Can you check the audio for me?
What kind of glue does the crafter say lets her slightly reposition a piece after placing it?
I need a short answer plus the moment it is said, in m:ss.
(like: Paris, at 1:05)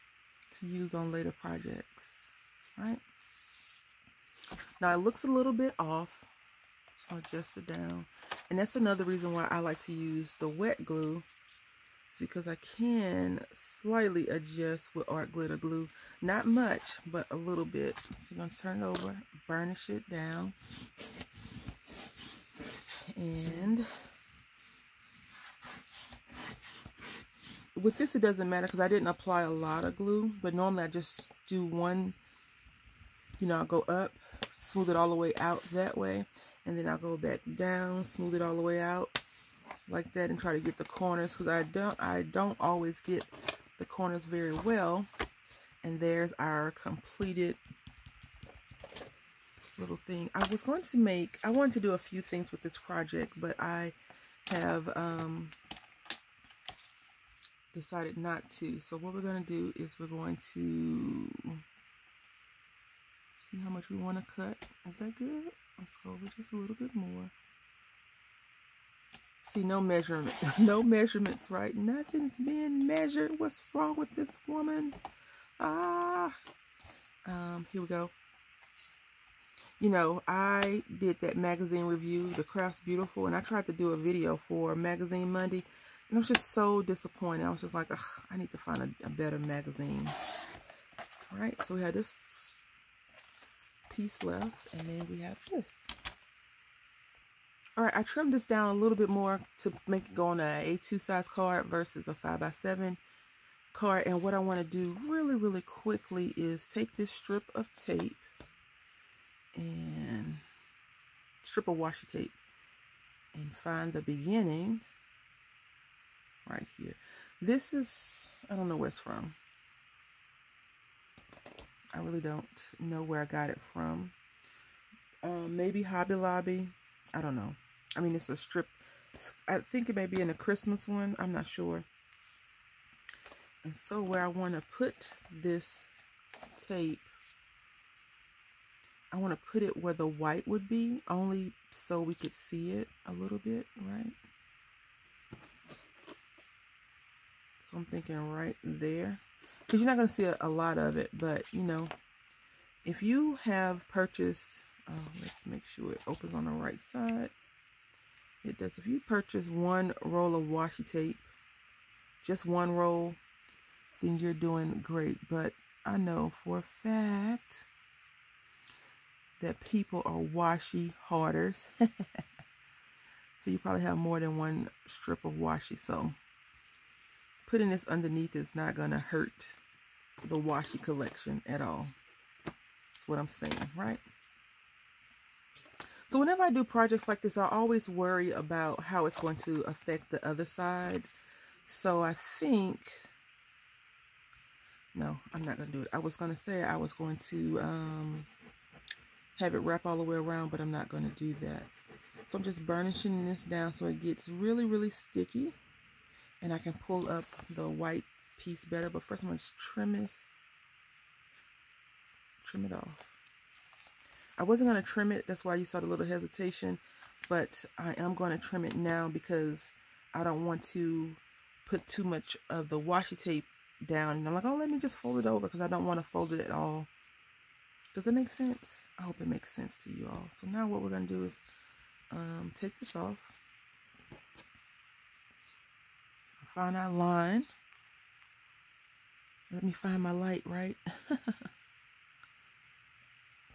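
Art glitter glue, at 0:15.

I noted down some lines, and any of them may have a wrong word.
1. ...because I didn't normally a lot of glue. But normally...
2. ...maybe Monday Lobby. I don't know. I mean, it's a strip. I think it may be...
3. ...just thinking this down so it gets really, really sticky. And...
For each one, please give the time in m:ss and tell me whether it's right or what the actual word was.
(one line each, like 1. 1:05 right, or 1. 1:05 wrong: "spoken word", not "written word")
1. 0:28 wrong: "apply", not "normally"
2. 2:05 wrong: "Hobby", not "Monday"
3. 3:22 wrong: "burnishing", not "thinking".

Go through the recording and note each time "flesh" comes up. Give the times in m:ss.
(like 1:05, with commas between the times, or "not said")
not said.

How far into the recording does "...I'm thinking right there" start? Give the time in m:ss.
2:27.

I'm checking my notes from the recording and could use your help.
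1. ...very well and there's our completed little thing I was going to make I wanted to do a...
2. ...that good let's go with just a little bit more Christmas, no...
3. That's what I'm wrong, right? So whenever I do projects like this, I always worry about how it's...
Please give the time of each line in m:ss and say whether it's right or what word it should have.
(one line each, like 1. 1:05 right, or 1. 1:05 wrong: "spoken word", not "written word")
1. 0:44 right
2. 1:04 wrong: "See", not "Christmas"
3. 3:02 wrong: "saying", not "wrong".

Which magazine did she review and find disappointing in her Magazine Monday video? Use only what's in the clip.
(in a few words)
The Craft's Beautiful.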